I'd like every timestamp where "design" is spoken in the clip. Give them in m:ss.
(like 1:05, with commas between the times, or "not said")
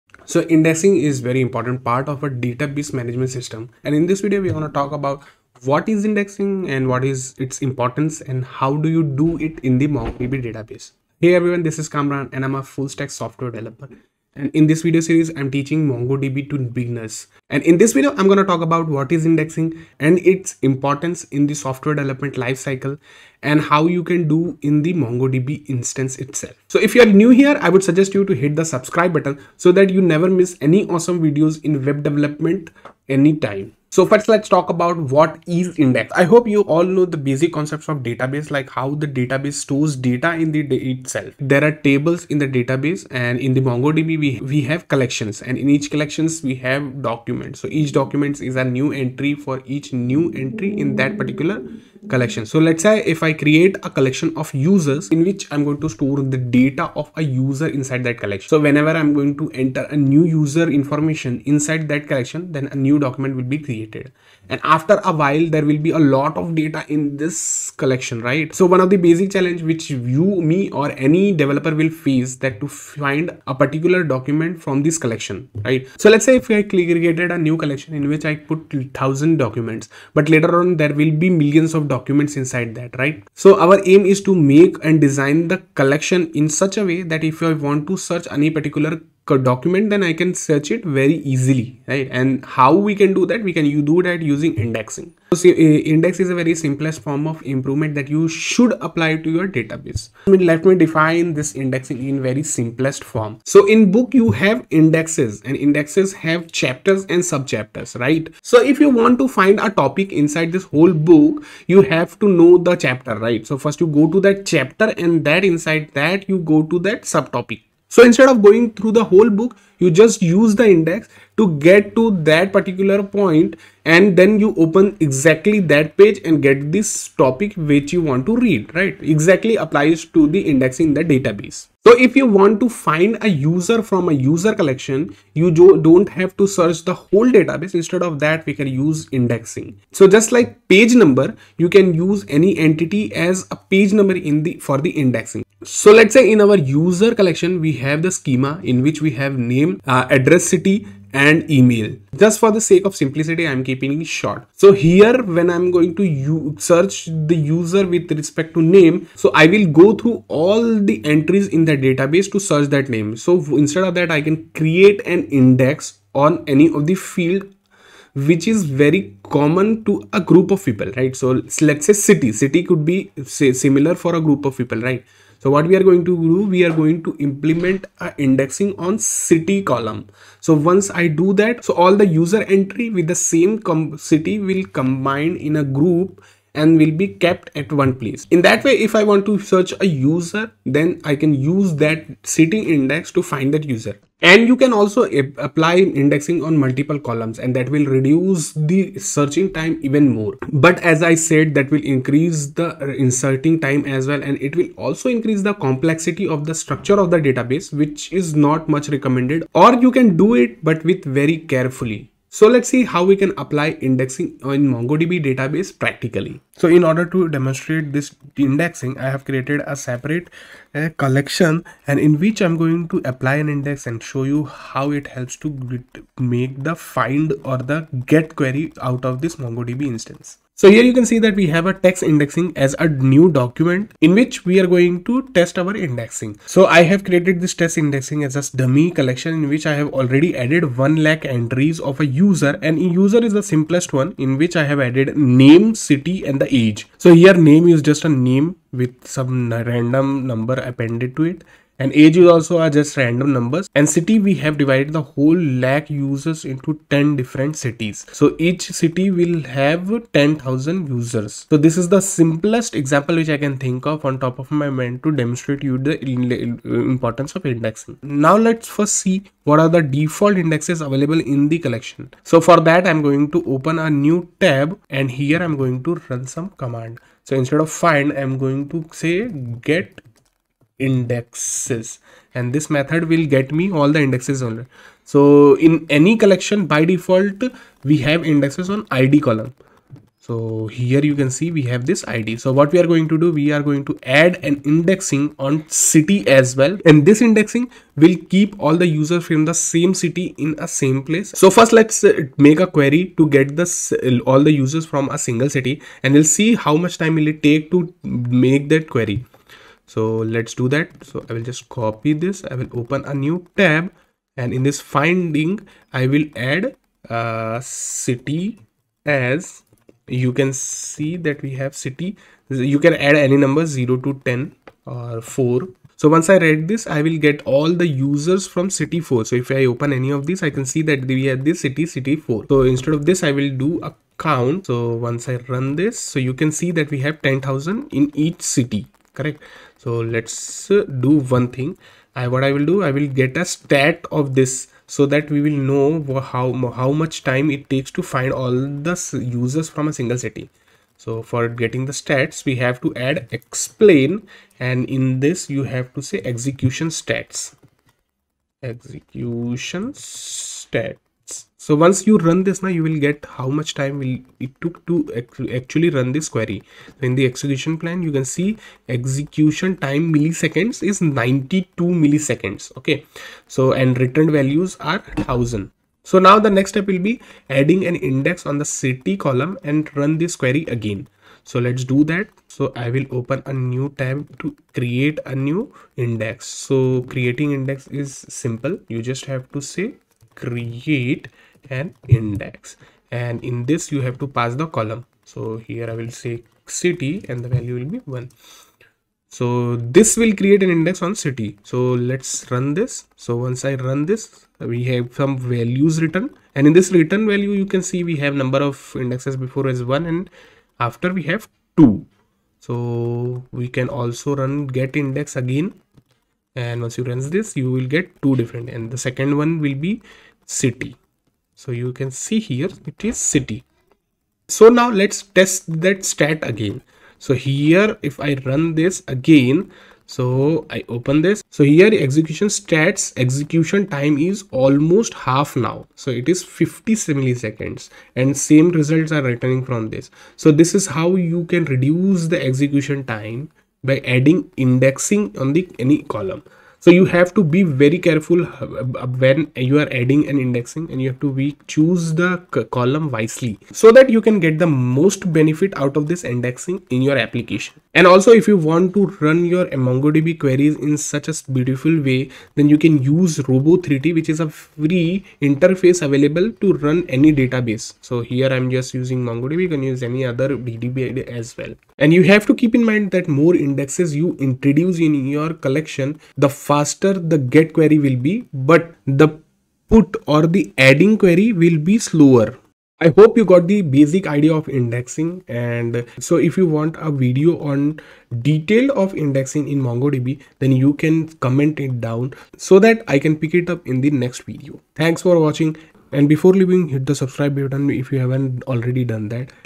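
1:25.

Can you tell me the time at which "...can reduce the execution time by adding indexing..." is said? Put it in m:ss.
7:21.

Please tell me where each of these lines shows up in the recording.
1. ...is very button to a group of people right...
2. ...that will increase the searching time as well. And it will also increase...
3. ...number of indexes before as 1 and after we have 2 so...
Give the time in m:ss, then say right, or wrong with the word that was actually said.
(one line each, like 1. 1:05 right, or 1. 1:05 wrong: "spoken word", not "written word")
1. 2:48 wrong: "common", not "button"
2. 3:21 wrong: "inserting", not "searching"
3. 6:48 right.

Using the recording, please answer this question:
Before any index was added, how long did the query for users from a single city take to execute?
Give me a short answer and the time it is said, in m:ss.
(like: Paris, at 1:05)
92 milliseconds, at 6:11.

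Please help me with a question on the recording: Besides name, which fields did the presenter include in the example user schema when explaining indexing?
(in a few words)
address, city and email.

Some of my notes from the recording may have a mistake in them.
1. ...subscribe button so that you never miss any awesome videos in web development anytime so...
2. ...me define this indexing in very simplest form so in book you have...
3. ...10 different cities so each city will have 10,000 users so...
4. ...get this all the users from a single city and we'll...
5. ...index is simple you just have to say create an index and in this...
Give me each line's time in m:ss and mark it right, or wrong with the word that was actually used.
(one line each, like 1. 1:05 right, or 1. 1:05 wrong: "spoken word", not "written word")
1. 0:28 right
2. 1:40 right
3. 4:16 right
4. 5:03 right
5. 6:27 right.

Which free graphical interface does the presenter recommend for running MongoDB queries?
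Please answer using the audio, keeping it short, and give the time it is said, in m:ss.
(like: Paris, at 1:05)
Robo3T, at 7:43.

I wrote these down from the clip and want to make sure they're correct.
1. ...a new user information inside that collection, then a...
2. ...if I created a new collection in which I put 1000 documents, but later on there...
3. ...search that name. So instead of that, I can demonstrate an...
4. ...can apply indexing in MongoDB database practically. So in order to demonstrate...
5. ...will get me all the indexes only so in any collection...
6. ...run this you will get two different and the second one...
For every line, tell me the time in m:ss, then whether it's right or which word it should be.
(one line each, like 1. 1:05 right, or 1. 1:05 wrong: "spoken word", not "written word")
1. 0:59 right
2. 1:16 right
3. 2:42 wrong: "create", not "demonstrate"
4. 3:33 right
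5. 4:43 right
6. 6:57 right.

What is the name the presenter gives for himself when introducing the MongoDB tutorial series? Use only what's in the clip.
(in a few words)
Kamran.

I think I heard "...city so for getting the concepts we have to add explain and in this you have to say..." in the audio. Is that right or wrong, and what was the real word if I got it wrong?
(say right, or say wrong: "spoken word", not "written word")
wrong: "stats", not "concepts".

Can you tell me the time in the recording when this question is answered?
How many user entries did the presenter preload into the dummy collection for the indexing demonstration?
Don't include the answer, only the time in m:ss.
4:00.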